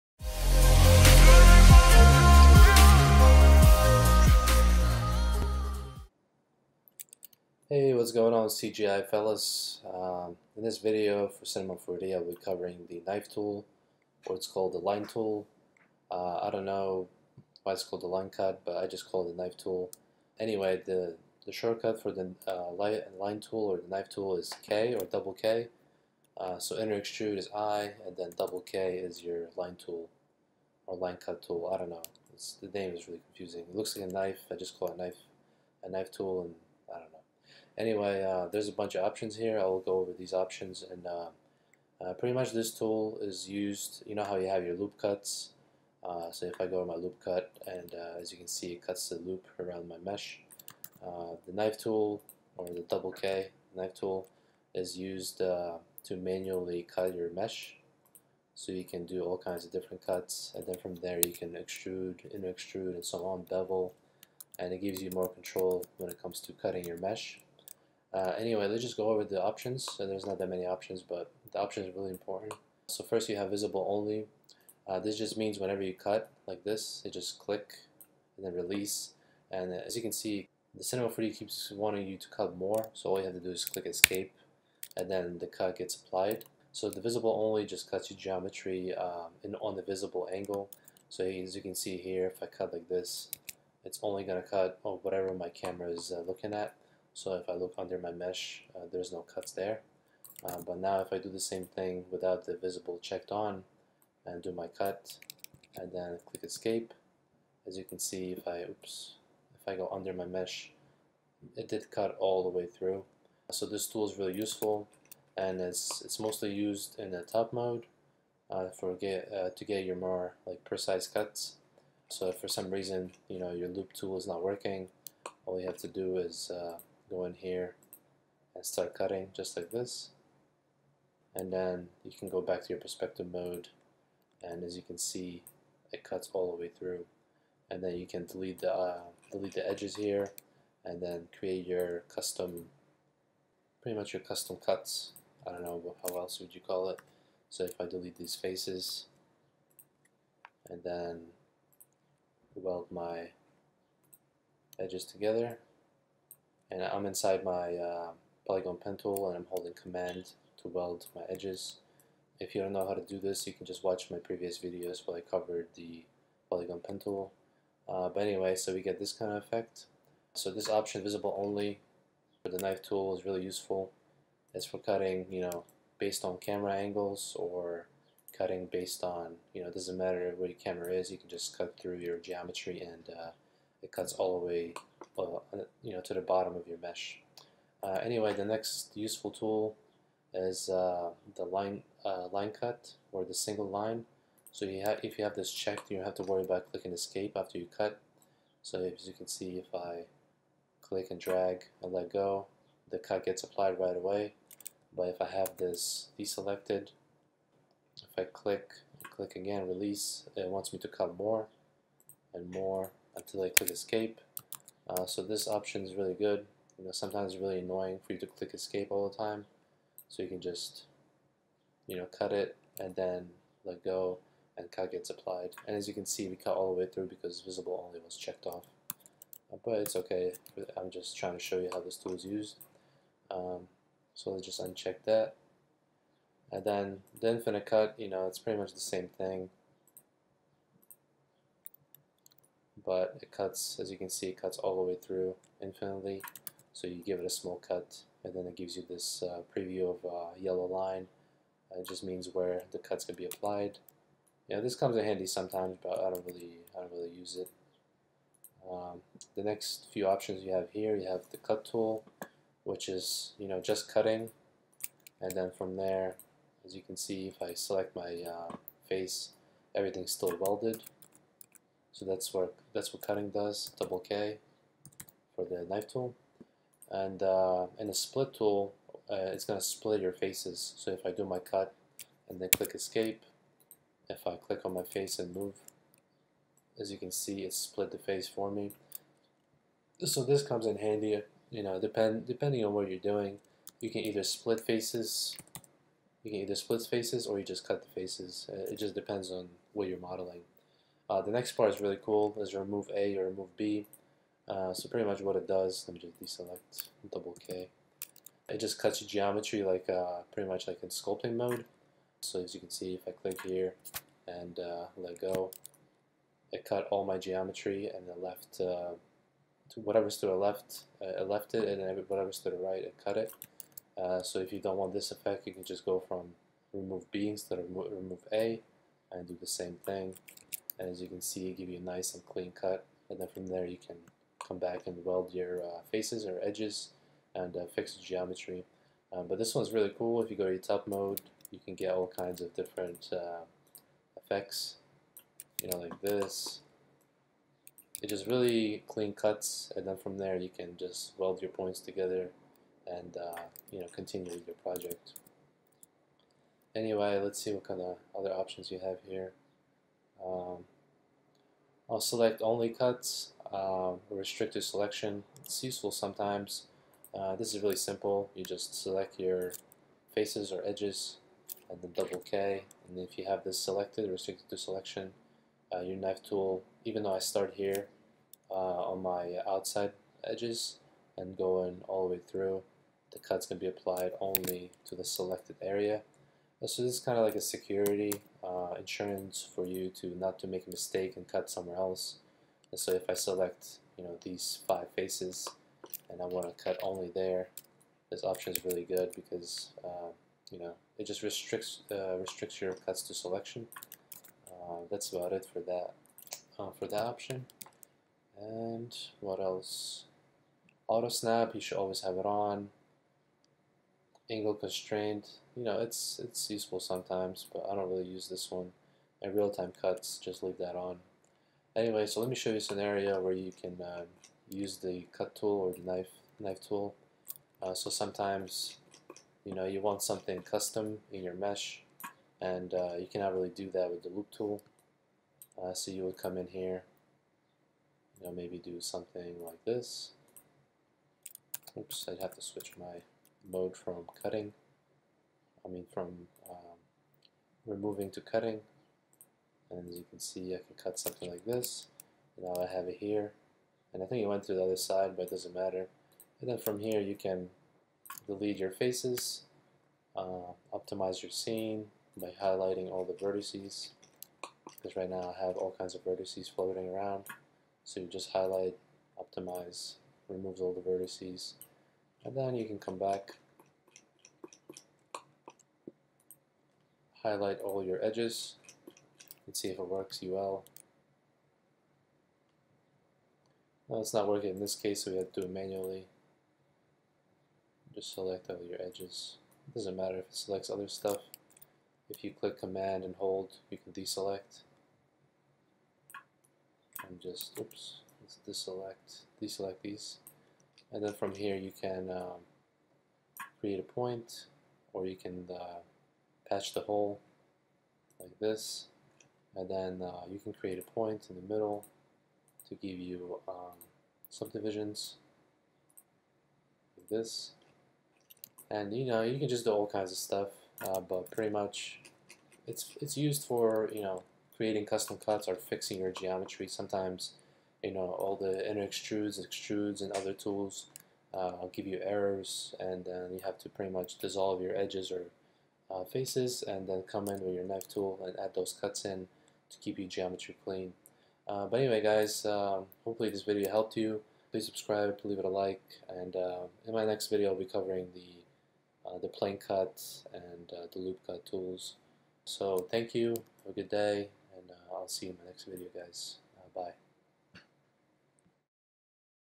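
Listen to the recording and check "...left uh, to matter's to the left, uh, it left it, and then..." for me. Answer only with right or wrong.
wrong.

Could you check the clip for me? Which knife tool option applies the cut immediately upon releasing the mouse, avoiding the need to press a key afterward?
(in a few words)
single line.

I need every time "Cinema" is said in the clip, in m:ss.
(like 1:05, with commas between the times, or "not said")
0:11, 1:20.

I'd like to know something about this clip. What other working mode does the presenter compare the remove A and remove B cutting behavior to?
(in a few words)
sculpting mode.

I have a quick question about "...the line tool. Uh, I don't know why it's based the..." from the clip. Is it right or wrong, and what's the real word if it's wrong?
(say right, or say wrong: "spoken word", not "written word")
wrong: "called", not "based".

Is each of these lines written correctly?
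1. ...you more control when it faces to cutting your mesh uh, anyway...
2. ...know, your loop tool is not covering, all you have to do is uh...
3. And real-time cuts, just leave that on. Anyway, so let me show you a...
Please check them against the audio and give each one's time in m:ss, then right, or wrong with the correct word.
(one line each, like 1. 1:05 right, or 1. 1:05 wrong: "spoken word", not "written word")
1. 1:05 wrong: "comes", not "faces"
2. 2:03 wrong: "working", not "covering"
3. 6:59 right.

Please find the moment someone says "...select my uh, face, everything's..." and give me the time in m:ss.
4:27.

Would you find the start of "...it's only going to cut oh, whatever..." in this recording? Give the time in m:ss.
1:33.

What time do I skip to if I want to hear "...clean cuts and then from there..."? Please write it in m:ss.
5:48.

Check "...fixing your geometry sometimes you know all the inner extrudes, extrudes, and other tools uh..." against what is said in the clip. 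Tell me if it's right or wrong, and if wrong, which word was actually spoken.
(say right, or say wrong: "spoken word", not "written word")
right.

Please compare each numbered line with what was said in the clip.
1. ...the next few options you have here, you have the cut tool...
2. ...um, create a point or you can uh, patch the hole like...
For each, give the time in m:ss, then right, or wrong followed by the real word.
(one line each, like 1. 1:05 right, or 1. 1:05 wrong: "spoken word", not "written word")
1. 4:19 right
2. 8:22 right.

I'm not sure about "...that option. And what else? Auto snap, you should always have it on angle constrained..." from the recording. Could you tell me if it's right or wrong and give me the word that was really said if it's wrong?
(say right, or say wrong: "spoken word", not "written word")
right.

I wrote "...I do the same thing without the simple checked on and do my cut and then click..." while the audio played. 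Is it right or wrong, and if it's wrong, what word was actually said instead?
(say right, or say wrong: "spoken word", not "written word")
wrong: "visible", not "simple".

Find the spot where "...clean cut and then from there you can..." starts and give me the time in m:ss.
5:32.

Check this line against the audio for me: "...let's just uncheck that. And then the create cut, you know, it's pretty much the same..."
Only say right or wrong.
wrong.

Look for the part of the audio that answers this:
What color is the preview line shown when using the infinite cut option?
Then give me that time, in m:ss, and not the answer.
4:10.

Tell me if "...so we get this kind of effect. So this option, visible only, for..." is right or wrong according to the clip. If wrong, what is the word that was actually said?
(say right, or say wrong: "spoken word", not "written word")
right.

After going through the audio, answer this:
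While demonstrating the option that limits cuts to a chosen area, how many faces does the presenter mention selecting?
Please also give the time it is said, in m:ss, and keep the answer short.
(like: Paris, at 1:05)
5, at 6:34.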